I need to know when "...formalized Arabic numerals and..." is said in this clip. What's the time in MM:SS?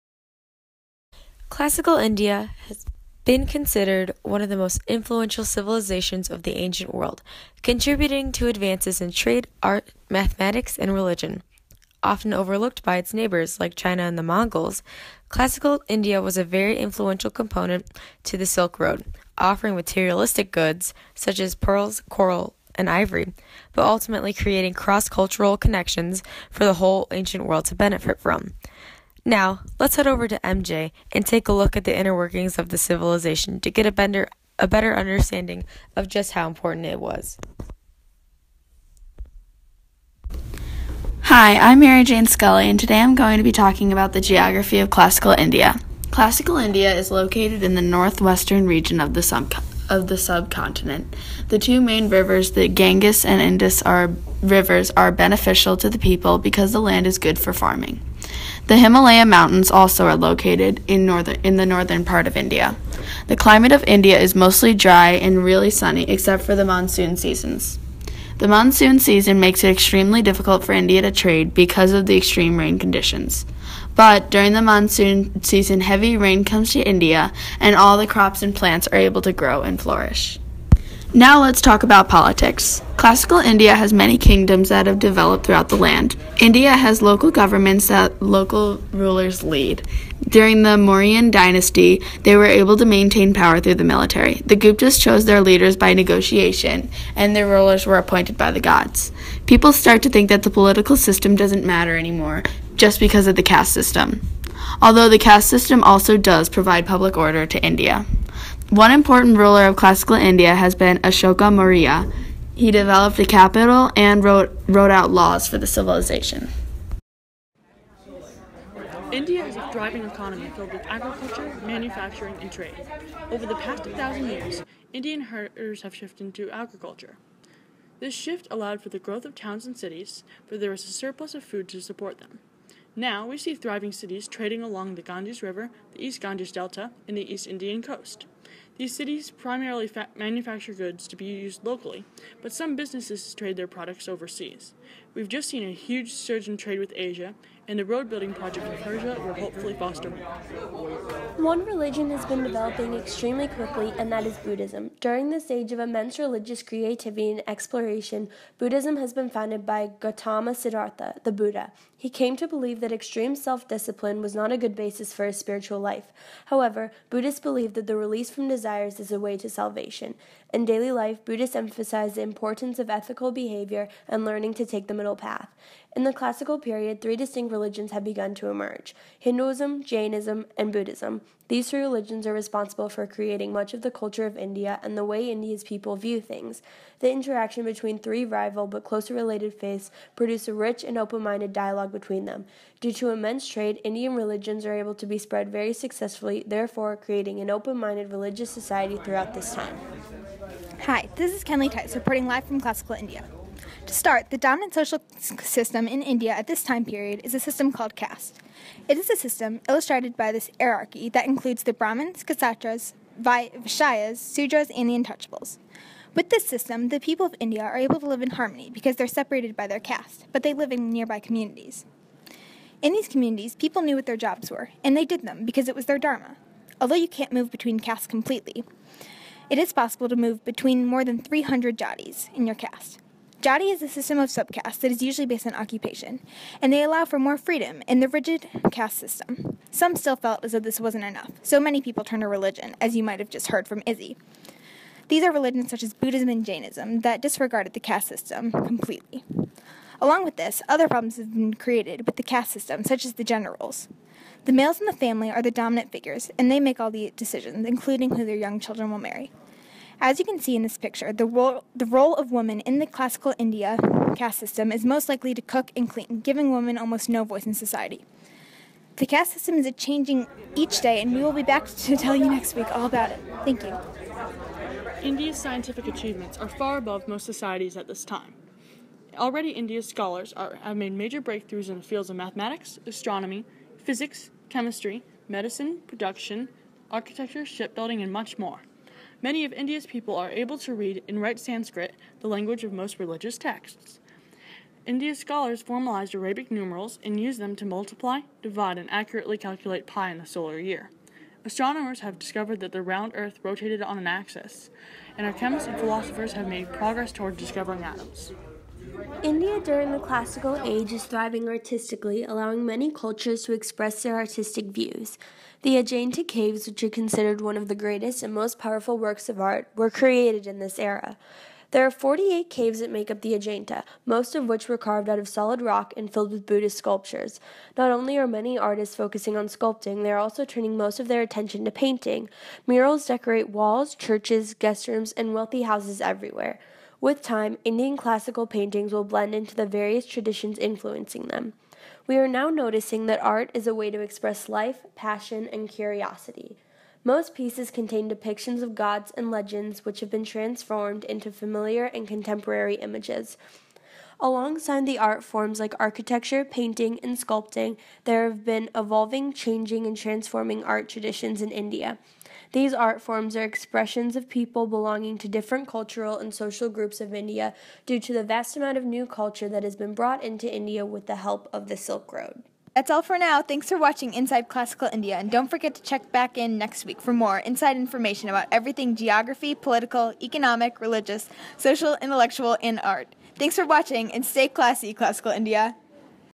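04:55.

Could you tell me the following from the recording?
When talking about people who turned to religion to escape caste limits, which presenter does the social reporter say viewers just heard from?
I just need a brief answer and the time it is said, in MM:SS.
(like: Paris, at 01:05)
Izzy, at 04:03.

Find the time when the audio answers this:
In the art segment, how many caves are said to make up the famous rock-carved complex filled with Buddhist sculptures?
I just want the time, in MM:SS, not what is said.
05:21.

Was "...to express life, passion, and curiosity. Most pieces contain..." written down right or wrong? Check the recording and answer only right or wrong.
right.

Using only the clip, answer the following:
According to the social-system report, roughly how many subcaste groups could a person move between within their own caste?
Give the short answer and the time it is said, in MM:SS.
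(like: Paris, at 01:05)
More than 300, at 03:50.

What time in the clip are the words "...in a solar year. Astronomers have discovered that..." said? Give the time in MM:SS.
05:00.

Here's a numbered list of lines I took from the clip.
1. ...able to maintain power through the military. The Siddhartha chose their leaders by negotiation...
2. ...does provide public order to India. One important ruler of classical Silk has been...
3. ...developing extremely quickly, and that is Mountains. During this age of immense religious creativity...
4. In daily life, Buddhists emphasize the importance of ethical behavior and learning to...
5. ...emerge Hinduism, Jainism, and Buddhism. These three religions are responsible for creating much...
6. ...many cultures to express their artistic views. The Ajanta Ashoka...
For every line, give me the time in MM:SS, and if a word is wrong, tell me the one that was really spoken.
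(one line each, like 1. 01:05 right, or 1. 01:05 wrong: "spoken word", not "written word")
1. 01:32 wrong: "Guptas", not "Siddhartha"
2. 01:46 wrong: "India", not "Silk"
3. 02:32 wrong: "Buddhism", not "Mountains"
4. 02:50 right
5. 02:58 right
6. 05:12 wrong: "Caves", not "Ashoka".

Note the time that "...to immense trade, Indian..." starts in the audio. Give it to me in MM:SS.
03:12.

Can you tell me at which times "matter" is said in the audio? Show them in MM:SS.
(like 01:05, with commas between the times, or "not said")
01:41.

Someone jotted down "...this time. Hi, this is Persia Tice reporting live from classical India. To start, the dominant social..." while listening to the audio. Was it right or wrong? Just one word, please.
wrong.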